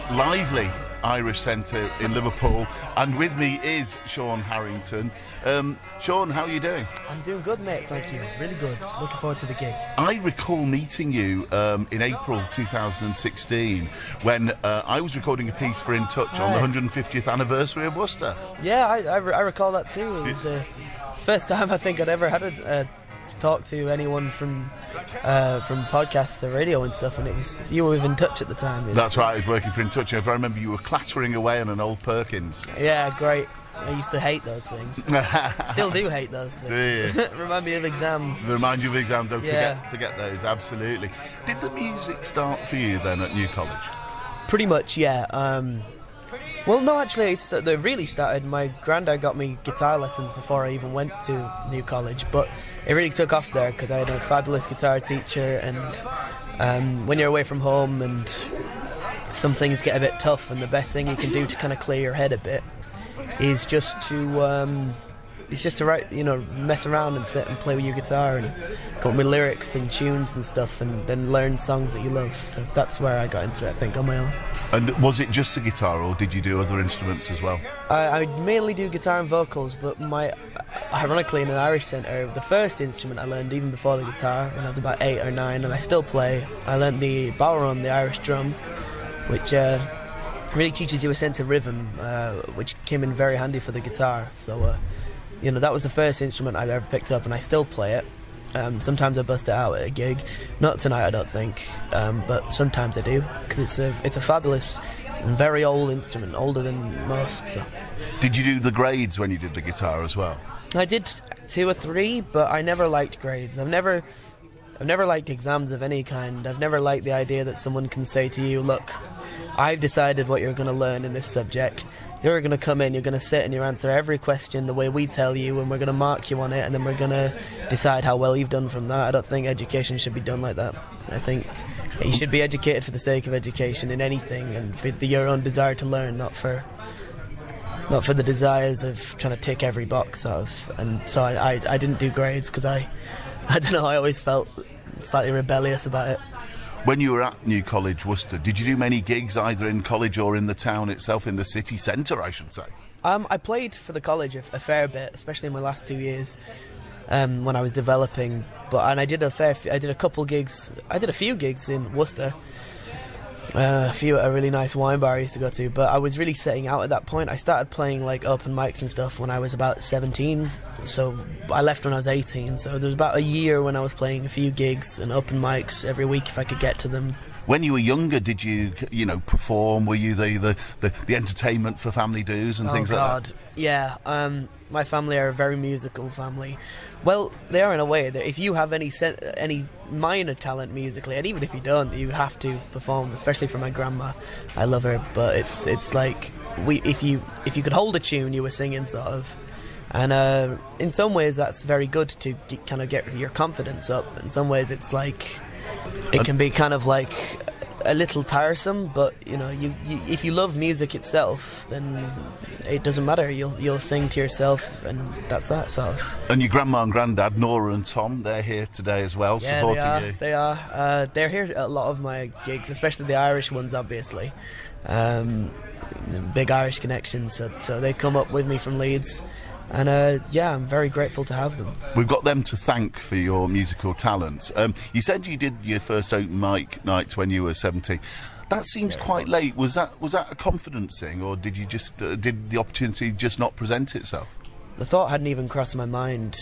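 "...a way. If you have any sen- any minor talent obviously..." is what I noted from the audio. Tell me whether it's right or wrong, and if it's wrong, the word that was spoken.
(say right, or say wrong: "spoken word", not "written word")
wrong: "musically", not "obviously".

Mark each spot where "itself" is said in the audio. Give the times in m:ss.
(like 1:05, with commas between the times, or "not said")
2:30, 3:30, 4:03.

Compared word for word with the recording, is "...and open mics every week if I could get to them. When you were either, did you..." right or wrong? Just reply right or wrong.
wrong.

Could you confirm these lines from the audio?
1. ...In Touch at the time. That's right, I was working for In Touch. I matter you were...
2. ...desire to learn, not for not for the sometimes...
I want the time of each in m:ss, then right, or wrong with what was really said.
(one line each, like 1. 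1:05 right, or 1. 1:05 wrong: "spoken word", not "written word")
1. 0:28 wrong: "remember", not "matter"
2. 2:15 wrong: "desires", not "sometimes".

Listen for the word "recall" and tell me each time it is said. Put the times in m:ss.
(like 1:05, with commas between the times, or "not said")
0:10, 0:19.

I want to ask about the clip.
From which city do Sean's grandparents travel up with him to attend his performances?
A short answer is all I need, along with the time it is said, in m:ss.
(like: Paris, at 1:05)
Leeds, at 3:48.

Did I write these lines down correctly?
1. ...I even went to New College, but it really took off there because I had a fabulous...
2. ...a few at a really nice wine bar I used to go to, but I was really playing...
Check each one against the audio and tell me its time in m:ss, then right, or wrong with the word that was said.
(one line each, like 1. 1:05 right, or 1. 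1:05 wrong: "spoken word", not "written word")
1. 0:50 right
2. 2:43 wrong: "setting", not "playing".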